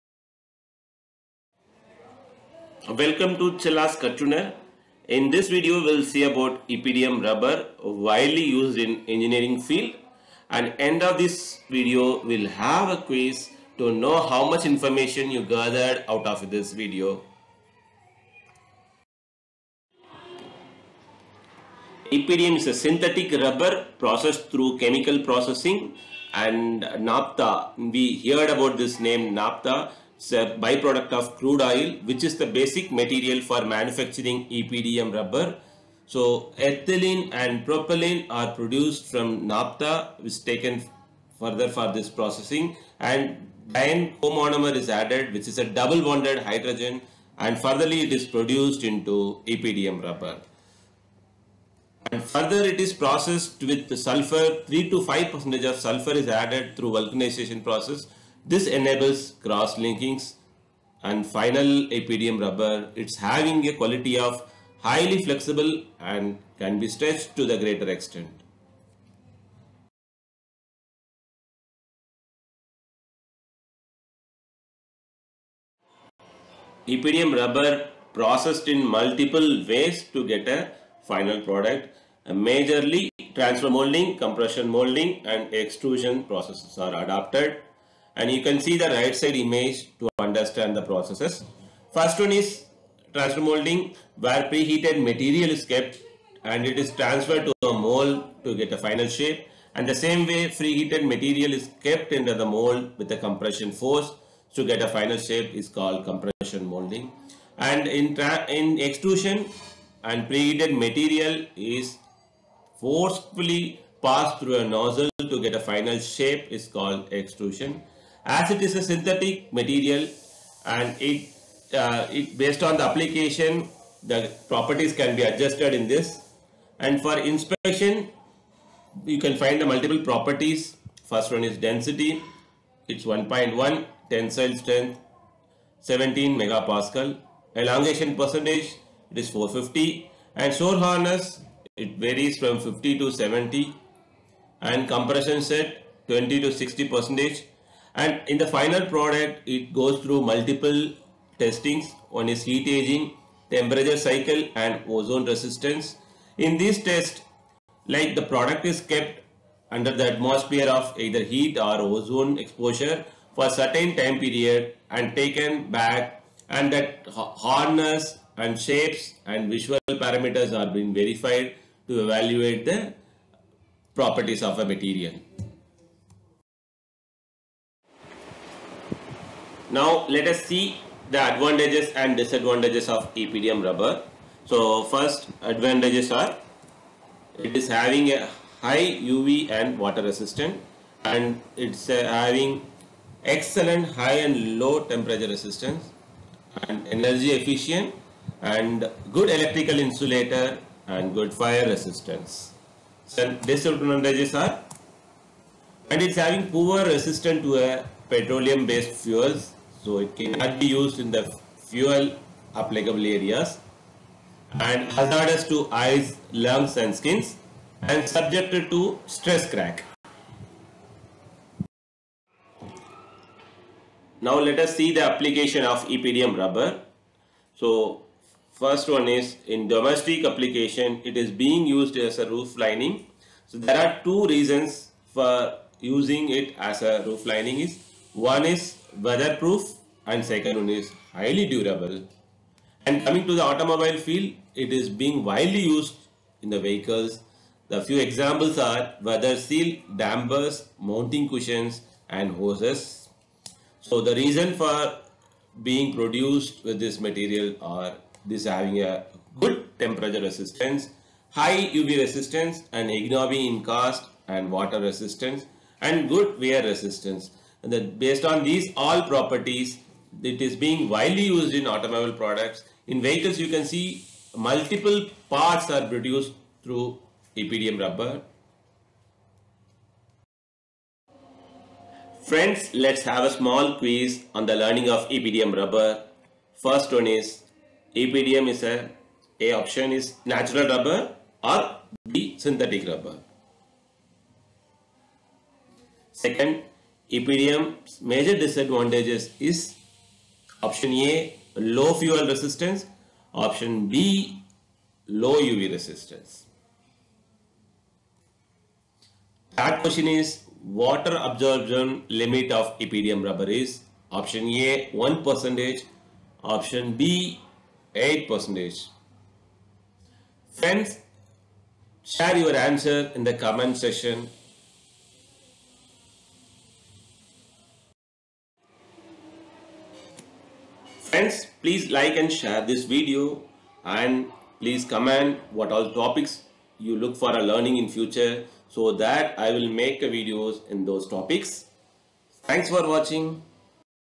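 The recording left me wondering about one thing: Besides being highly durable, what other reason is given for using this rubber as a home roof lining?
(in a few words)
Weatherproof.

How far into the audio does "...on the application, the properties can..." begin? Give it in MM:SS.
02:02.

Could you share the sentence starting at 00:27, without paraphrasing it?
We heard about this name naphtha it's a byproduct of crude oil, which is the basic material for manufacturing EPDM rubber.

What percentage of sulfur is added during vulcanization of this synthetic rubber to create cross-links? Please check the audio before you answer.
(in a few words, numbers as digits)
3 to 5 percent.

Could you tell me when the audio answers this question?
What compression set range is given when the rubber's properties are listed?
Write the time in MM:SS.
02:26.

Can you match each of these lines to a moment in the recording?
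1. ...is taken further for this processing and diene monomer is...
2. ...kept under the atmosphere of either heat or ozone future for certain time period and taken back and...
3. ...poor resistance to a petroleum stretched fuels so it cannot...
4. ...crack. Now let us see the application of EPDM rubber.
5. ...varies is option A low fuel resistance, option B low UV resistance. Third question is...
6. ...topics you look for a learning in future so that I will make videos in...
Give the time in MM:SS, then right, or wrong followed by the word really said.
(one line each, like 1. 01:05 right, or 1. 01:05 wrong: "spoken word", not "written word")
1. 00:40 right
2. 02:38 wrong: "exposure", not "future"
3. 03:26 wrong: "based", not "stretched"
4. 03:39 right
5. 04:58 wrong: "disadvantages", not "varies"
6. 05:35 right.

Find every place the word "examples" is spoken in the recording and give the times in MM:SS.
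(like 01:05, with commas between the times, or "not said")
04:07.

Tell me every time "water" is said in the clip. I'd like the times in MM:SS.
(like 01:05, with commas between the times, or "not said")
03:09, 04:24, 05:10.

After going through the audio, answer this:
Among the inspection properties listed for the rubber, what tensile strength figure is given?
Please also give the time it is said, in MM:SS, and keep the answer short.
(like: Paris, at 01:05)
17 megapascal, at 02:15.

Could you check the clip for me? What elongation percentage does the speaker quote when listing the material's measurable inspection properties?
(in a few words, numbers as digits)
450.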